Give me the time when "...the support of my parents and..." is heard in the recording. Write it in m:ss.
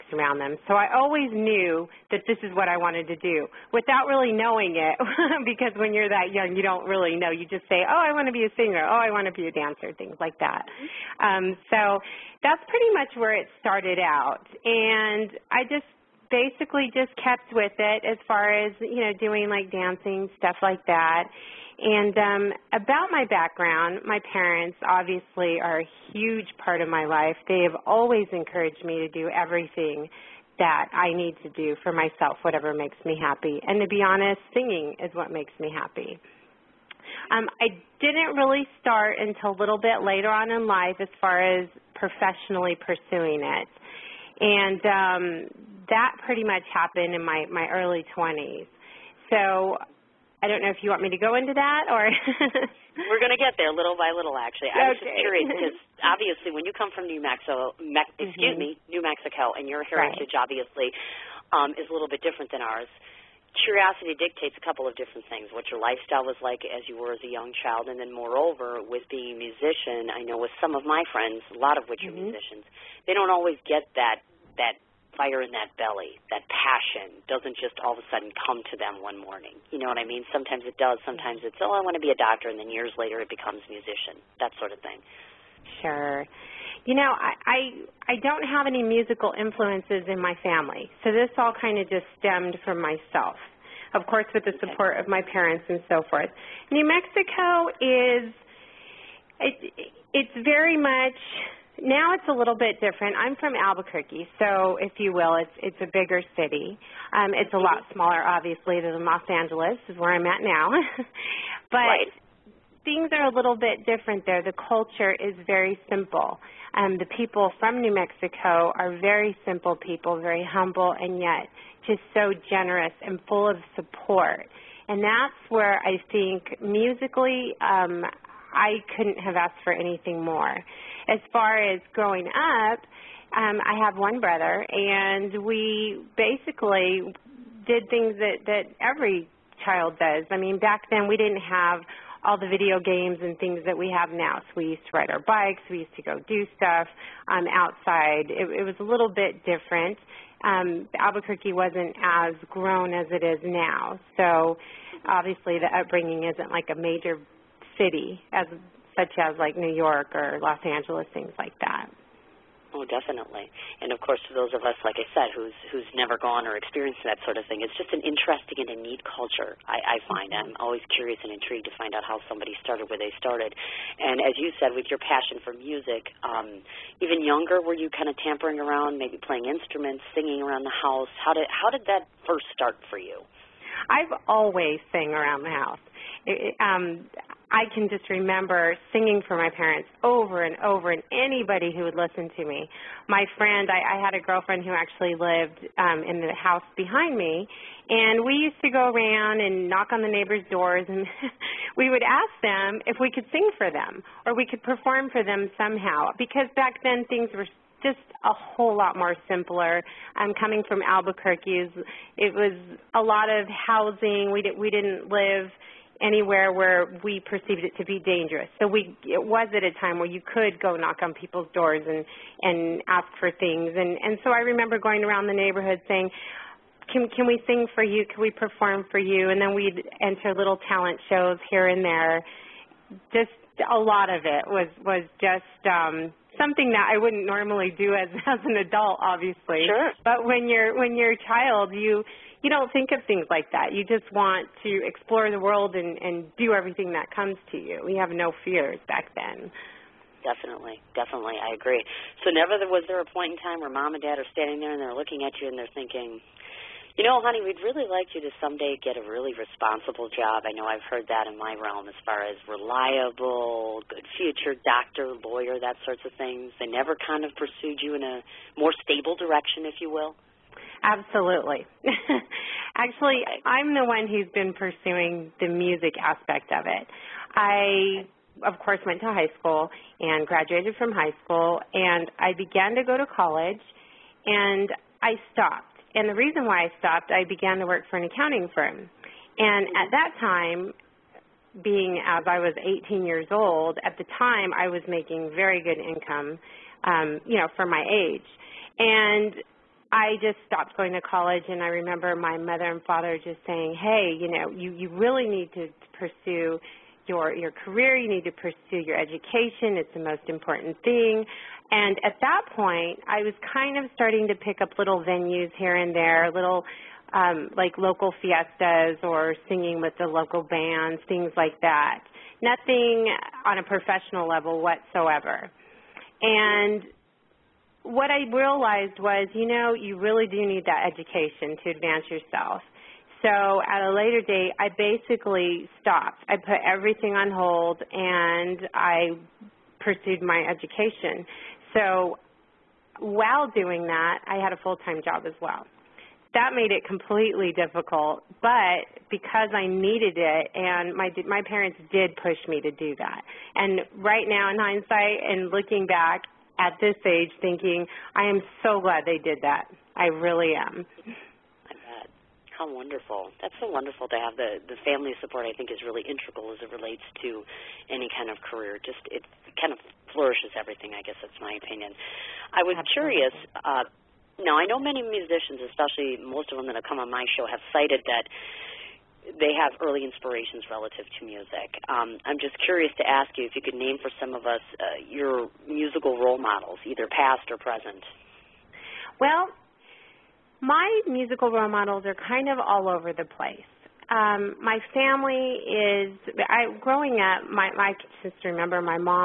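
1:34.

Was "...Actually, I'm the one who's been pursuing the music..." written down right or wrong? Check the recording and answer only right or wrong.
right.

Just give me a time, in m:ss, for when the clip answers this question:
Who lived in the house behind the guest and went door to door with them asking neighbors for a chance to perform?
3:14.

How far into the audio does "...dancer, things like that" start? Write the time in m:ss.
0:09.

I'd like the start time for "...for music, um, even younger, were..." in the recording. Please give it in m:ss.
2:55.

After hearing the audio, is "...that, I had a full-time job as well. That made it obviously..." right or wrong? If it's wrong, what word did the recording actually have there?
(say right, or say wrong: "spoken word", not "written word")
wrong: "completely", not "obviously".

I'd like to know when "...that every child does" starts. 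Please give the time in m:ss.
2:18.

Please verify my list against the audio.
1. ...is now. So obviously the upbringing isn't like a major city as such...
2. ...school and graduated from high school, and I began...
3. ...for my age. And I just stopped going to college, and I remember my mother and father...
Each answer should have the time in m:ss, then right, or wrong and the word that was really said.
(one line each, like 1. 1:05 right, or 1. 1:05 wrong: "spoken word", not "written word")
1. 2:33 right
2. 4:39 right
3. 4:57 right.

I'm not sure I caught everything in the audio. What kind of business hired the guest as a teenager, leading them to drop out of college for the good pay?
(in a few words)
An accounting firm.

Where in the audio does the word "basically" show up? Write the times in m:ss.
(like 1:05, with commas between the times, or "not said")
0:16, 2:16, 5:34.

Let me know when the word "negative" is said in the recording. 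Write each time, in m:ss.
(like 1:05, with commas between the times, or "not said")
not said.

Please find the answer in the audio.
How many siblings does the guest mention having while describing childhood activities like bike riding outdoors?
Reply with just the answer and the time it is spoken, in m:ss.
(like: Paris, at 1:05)
1 brother, at 2:13.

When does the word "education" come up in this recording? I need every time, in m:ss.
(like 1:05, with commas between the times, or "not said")
5:08, 5:30, 5:40.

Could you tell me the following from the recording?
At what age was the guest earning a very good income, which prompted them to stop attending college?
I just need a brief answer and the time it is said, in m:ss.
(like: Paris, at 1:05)
18, at 4:52.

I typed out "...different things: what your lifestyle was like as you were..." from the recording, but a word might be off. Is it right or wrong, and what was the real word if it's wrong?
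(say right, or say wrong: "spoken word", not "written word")
right.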